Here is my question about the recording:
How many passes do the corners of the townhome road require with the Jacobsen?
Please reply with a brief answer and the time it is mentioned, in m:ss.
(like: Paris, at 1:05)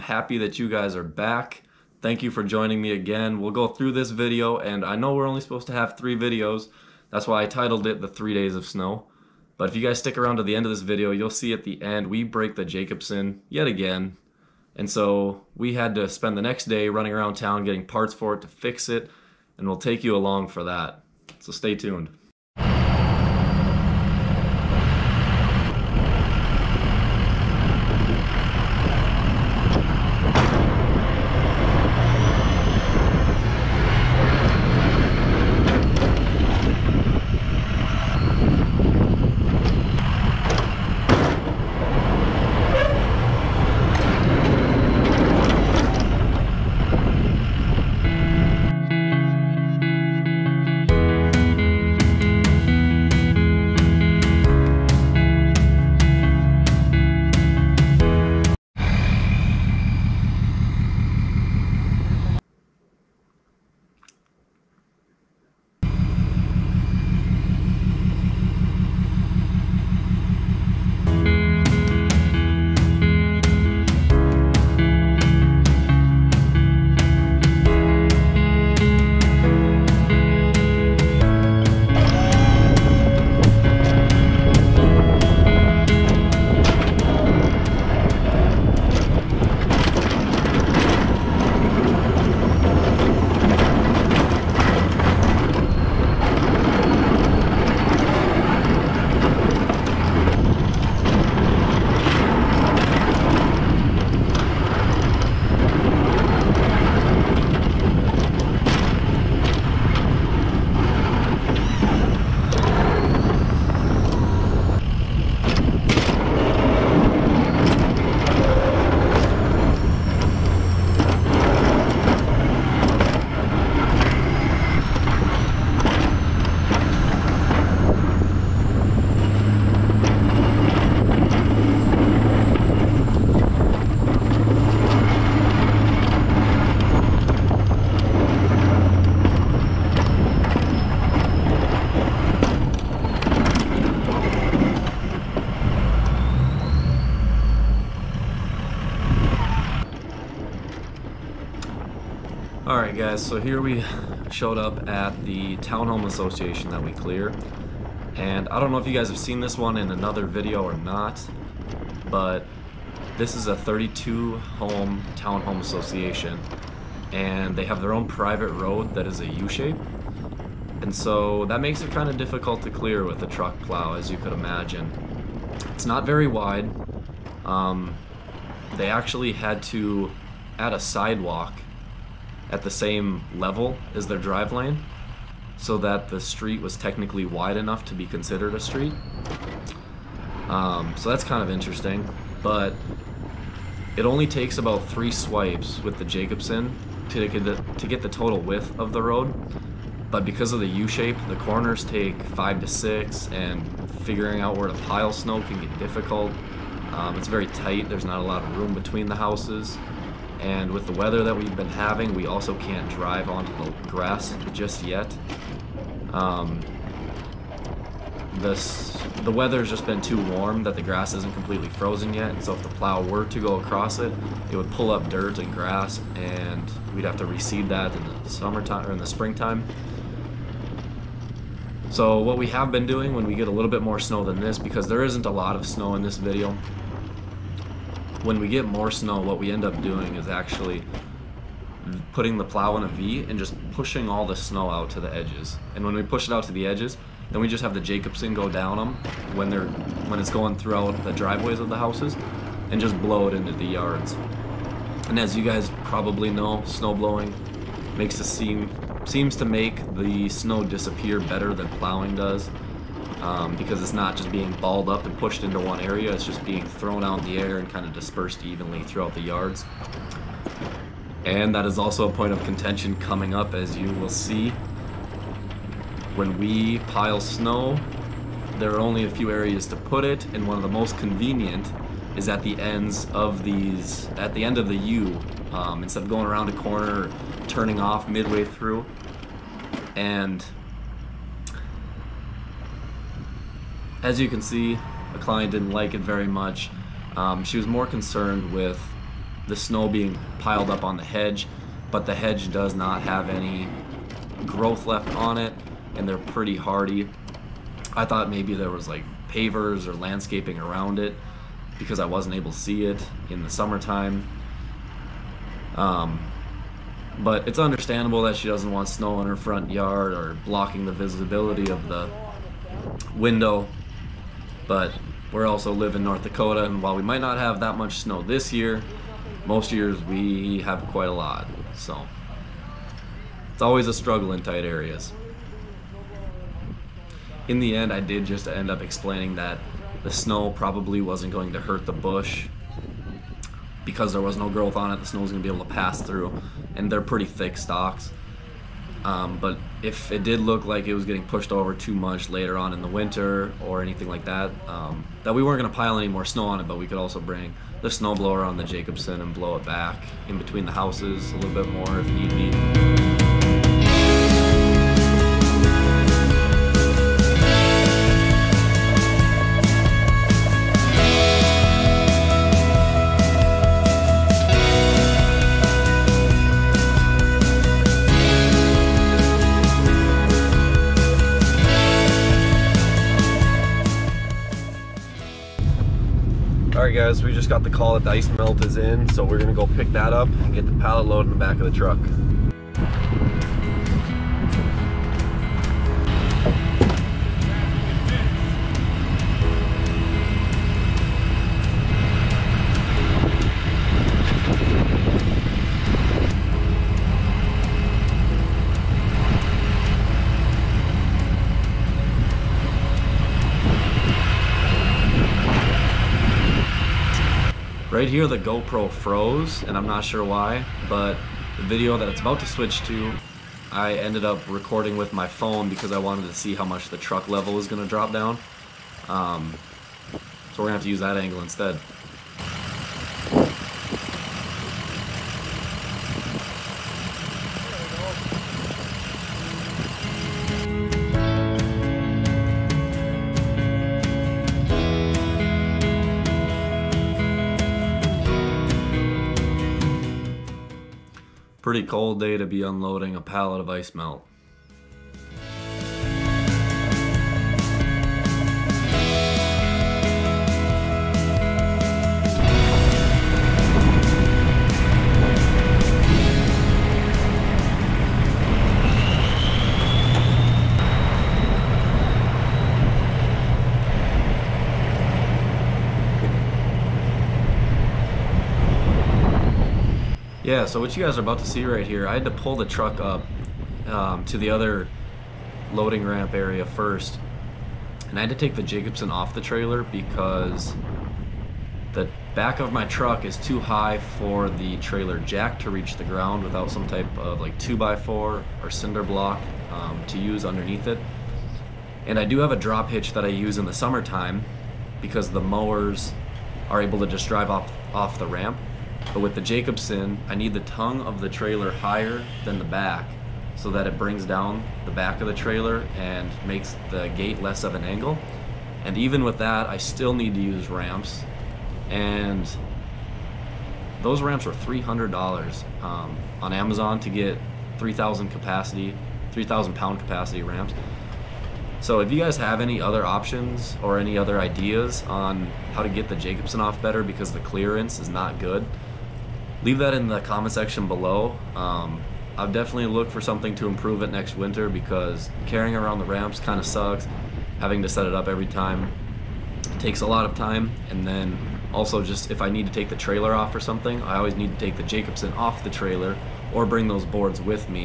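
5 to 6, at 3:22.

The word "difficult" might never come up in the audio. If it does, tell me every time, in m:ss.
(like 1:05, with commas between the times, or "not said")
2:52, 3:25.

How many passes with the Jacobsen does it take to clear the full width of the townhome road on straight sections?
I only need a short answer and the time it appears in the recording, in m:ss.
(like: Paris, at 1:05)
3, at 3:14.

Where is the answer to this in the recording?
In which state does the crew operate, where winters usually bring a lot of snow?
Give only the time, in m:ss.
5:26.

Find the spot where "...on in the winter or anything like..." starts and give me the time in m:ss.
5:52.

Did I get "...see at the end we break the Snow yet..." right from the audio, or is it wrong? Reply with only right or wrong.
wrong.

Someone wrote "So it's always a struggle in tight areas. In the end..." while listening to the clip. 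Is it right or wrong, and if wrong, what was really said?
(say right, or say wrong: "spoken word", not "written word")
right.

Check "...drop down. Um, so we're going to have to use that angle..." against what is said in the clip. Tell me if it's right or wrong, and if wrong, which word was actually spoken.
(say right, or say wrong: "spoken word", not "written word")
right.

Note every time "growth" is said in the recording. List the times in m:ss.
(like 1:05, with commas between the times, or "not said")
5:04, 5:44.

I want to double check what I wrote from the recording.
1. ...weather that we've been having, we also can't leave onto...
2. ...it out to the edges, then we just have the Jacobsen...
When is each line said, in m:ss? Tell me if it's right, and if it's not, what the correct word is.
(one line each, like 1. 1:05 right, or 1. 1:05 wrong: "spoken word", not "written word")
1. 3:30 wrong: "drive", not "leave"
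2. 4:06 right.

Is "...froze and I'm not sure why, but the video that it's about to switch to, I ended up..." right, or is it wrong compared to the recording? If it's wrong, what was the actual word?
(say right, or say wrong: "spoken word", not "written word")
right.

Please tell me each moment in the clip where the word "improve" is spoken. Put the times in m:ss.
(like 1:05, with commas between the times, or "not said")
9:03.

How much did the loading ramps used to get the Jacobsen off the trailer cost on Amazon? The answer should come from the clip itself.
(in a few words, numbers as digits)
$300.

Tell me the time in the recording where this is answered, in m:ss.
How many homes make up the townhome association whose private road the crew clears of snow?
2:43.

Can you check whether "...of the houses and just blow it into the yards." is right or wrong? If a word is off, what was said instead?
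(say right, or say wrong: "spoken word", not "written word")
right.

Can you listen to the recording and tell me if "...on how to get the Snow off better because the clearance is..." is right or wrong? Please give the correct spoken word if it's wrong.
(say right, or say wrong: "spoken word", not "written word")
wrong: "Jacobsen", not "Snow".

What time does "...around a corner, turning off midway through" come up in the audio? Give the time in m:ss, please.
4:46.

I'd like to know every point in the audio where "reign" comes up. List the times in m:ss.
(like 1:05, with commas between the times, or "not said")
not said.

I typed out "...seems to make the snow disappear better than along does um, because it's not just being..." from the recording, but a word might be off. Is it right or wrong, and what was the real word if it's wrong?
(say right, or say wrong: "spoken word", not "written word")
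wrong: "plowing", not "along".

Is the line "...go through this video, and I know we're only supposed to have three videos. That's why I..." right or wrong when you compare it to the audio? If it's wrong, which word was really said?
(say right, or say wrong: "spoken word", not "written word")
right.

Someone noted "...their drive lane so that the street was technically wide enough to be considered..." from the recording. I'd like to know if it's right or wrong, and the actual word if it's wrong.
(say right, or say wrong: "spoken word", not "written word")
right.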